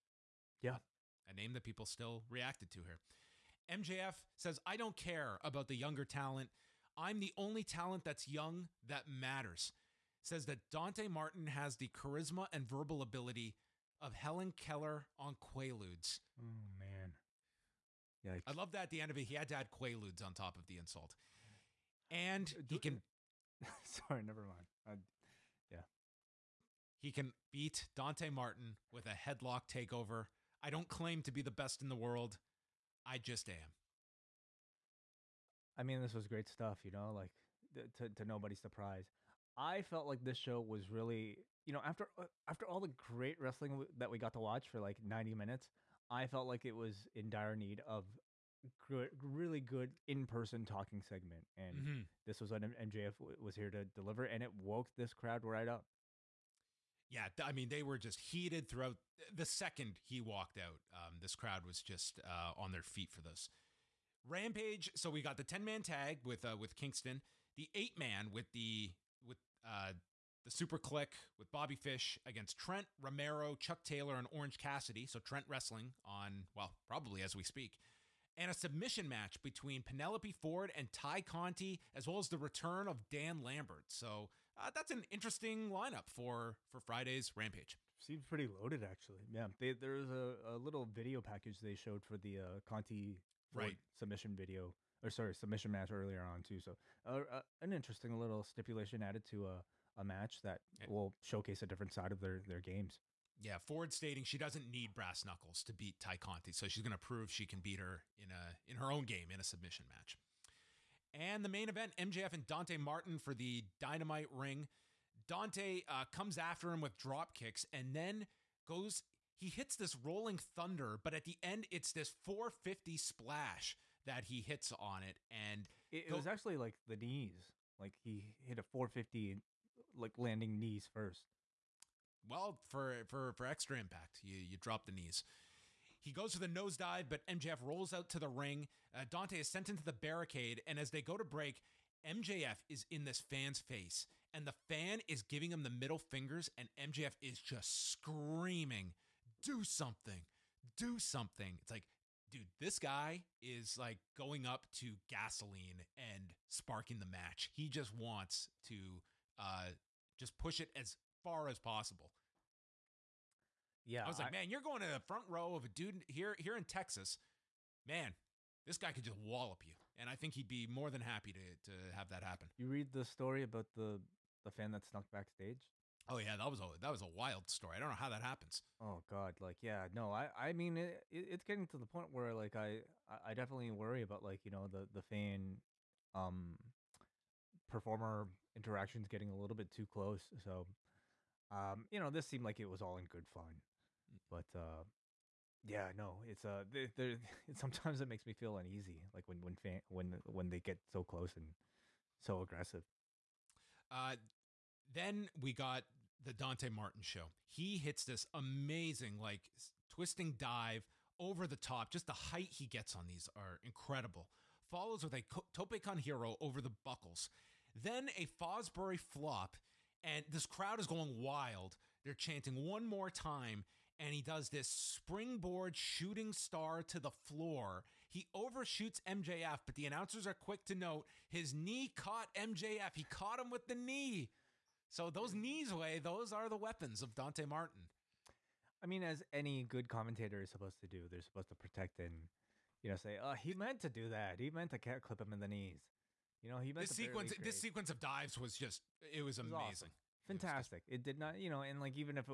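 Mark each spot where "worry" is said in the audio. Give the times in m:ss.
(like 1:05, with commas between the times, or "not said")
3:03.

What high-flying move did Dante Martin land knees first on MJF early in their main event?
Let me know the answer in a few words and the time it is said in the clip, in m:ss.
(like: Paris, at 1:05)
450 splash, at 2:02.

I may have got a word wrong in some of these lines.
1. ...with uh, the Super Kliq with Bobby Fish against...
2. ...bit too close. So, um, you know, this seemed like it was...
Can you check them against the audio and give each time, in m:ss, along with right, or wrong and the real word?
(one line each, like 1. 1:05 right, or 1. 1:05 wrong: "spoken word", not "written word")
1. 1:09 right
2. 3:09 right.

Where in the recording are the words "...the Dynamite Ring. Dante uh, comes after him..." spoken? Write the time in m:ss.
1:53.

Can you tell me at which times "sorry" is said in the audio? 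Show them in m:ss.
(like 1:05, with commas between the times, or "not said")
0:23, 1:35.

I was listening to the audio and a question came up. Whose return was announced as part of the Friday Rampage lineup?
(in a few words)
Dan Lambert.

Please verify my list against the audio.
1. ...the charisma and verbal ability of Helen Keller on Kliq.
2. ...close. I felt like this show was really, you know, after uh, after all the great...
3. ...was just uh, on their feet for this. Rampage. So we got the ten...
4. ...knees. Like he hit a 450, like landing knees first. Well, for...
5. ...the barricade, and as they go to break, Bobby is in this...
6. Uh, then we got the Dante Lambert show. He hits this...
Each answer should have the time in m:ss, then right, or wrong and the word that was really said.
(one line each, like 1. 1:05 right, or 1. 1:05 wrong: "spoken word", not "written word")
1. 0:11 wrong: "Quaaludes", not "Kliq"
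2. 0:38 wrong: "surprise", not "close"
3. 1:01 right
4. 2:06 right
5. 2:19 wrong: "MJF", not "Bobby"
6. 3:23 wrong: "Martin", not "Lambert".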